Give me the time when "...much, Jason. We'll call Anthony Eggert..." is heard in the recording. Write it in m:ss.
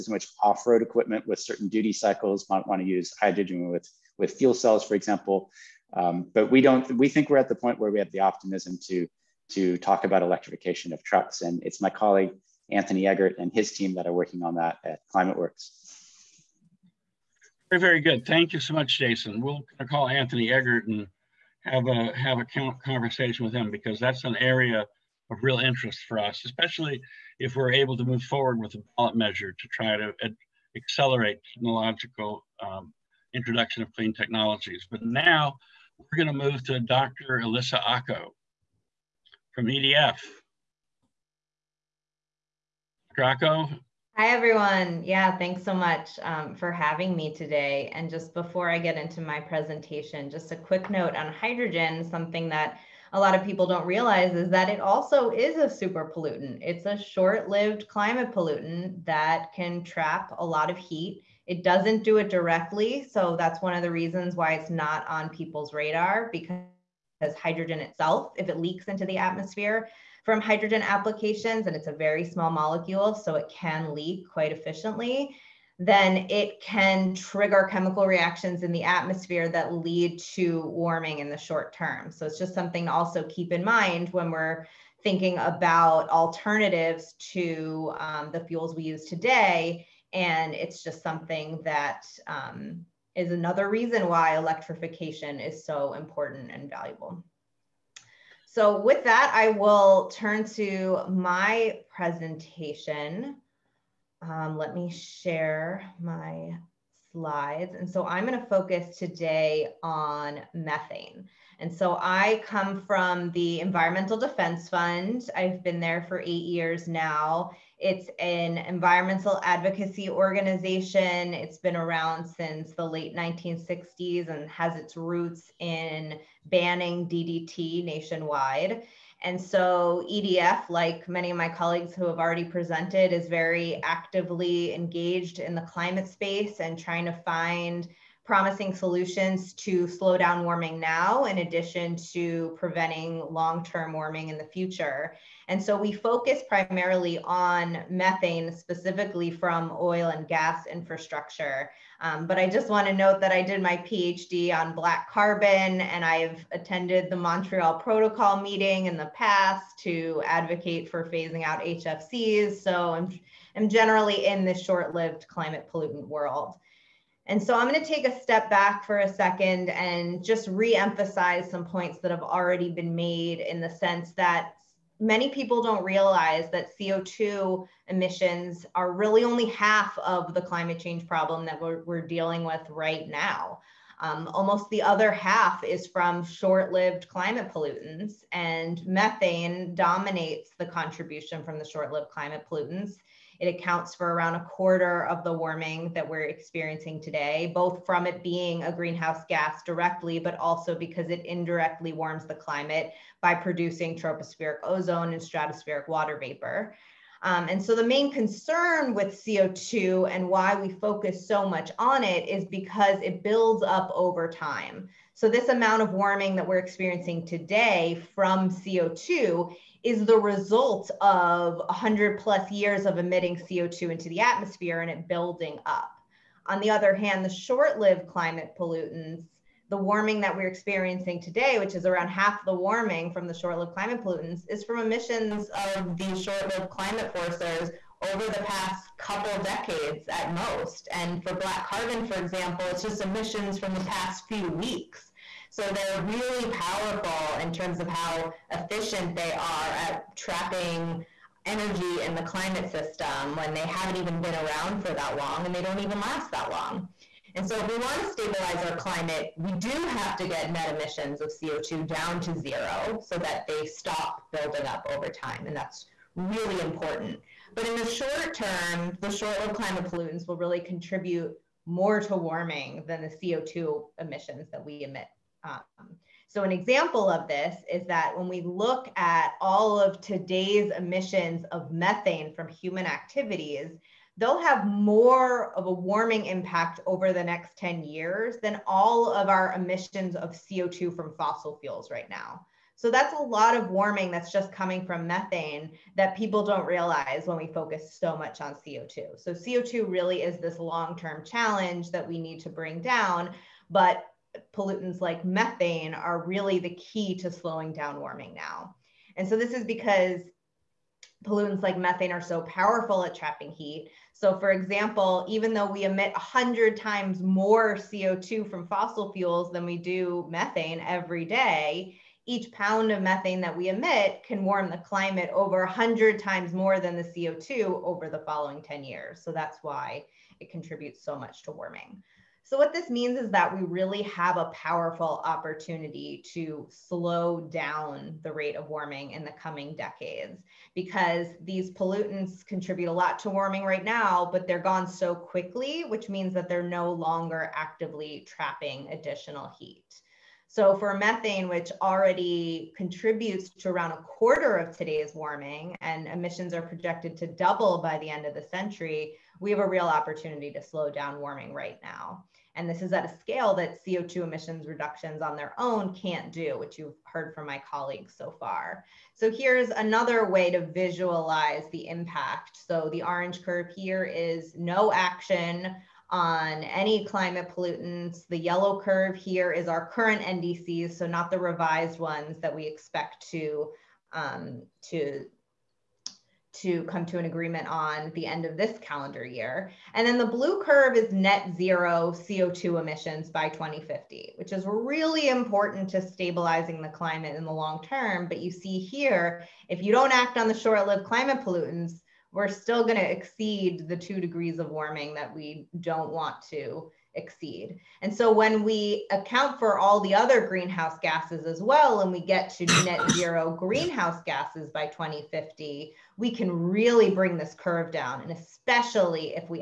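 0:18.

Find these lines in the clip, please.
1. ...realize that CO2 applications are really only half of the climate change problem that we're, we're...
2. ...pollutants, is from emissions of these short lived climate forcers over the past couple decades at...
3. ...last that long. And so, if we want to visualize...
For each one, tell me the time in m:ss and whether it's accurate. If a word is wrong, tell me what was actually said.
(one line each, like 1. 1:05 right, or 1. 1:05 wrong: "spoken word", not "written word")
1. 2:55 wrong: "emissions", not "applications"
2. 3:54 right
3. 4:15 wrong: "stabilize", not "visualize".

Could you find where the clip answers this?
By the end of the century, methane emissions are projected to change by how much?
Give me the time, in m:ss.
5:57.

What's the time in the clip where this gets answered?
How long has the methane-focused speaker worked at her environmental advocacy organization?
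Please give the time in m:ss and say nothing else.
1:56.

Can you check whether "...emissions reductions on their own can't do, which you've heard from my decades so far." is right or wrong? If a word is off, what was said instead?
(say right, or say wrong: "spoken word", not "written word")
wrong: "colleagues", not "decades".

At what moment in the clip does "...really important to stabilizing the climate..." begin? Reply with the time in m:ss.
6:34.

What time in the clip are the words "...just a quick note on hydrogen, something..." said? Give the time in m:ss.
0:50.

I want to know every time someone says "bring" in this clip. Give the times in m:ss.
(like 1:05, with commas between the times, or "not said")
5:02, 6:57.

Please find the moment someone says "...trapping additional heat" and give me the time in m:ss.
5:48.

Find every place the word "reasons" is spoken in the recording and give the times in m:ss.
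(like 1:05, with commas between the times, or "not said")
1:03, 1:33.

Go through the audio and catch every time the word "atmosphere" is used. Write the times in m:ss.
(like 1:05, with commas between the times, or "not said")
1:09, 1:18, 3:44.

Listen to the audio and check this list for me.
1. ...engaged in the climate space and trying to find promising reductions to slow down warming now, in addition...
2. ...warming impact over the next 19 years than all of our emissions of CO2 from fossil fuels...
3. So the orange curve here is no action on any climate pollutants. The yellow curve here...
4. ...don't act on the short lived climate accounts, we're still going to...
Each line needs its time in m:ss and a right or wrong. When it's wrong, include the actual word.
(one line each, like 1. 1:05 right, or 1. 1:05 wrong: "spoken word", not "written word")
1. 2:14 wrong: "solutions", not "reductions"
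2. 4:45 wrong: "10", not "19"
3. 6:12 right
4. 6:39 wrong: "pollutants", not "accounts".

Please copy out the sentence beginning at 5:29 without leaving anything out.
So that's why it contributes so much to warming.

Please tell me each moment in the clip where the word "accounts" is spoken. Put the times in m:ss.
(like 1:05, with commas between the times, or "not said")
3:13, 6:49.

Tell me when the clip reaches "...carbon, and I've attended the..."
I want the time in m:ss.
2:35.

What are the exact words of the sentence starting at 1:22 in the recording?
So it's just something to also keep in mind when we're thinking about alternatives to um, the fuels we use today.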